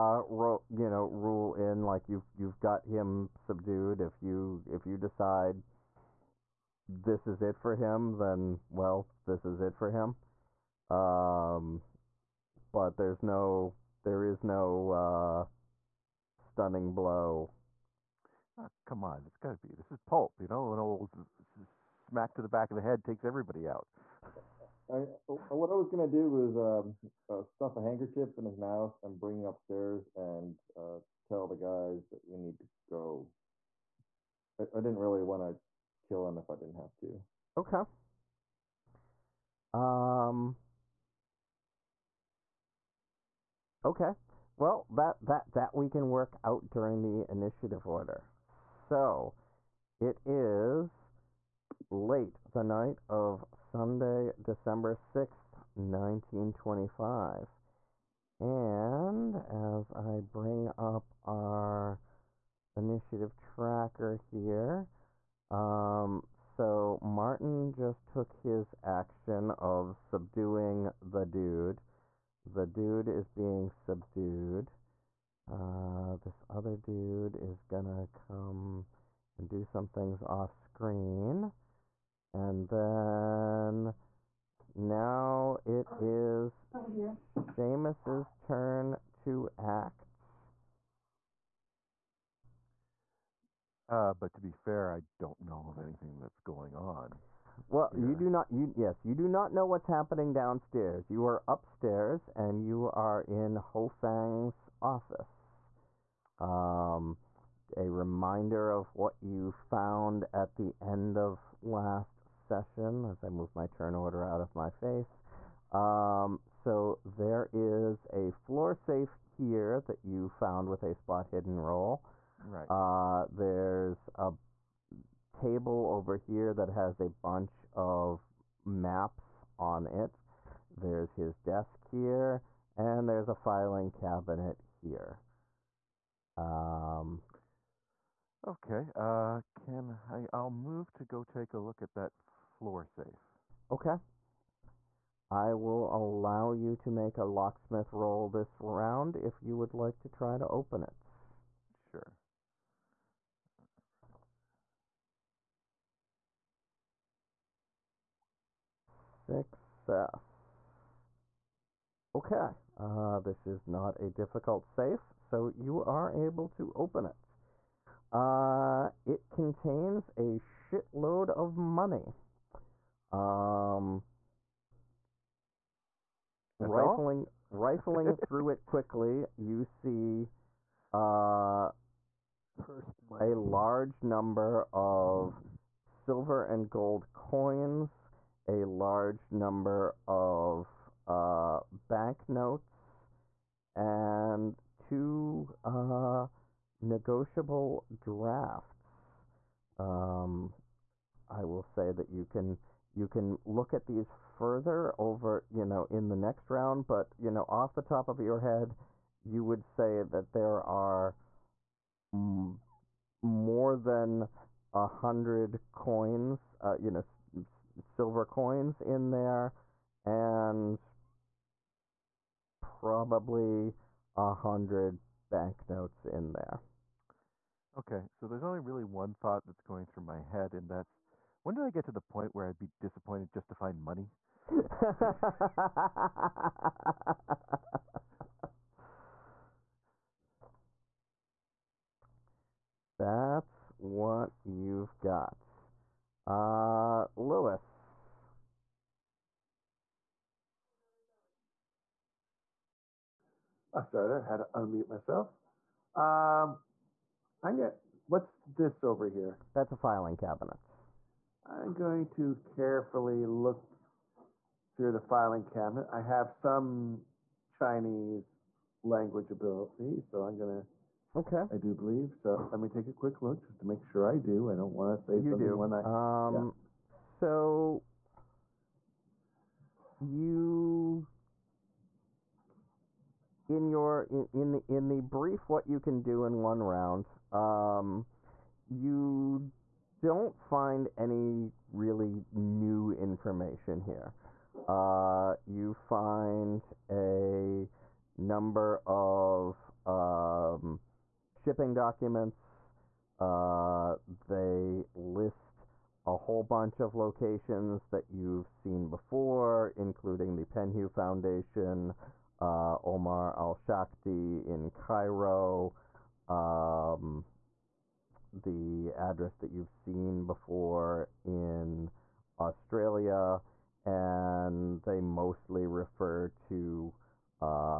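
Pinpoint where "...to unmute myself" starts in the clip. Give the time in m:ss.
4:14.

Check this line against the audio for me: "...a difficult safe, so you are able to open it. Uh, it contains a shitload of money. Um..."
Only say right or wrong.
right.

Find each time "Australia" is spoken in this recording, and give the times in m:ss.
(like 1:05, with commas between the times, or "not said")
5:22.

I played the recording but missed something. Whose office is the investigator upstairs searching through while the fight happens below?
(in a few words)
Ho Fang.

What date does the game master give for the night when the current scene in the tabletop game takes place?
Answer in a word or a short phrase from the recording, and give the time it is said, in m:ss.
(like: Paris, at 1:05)
December 6th, 1925, at 0:54.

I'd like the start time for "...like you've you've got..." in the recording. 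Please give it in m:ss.
0:01.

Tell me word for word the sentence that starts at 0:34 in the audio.
I, I didn't really want to kill him if I didn't have to.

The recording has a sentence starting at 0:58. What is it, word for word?
And as I bring up our initiative tracker here, um, so Martin just took his action of subduing the dude.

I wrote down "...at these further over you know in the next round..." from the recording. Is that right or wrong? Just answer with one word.
right.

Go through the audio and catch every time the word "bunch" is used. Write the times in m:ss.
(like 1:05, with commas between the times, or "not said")
2:07, 5:06.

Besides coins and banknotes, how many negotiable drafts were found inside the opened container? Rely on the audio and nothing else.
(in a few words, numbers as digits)
2.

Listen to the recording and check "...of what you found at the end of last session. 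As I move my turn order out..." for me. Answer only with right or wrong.
right.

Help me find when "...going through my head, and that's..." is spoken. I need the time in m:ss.
3:49.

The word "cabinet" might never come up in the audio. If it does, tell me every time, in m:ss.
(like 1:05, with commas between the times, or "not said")
2:13, 4:20, 4:25.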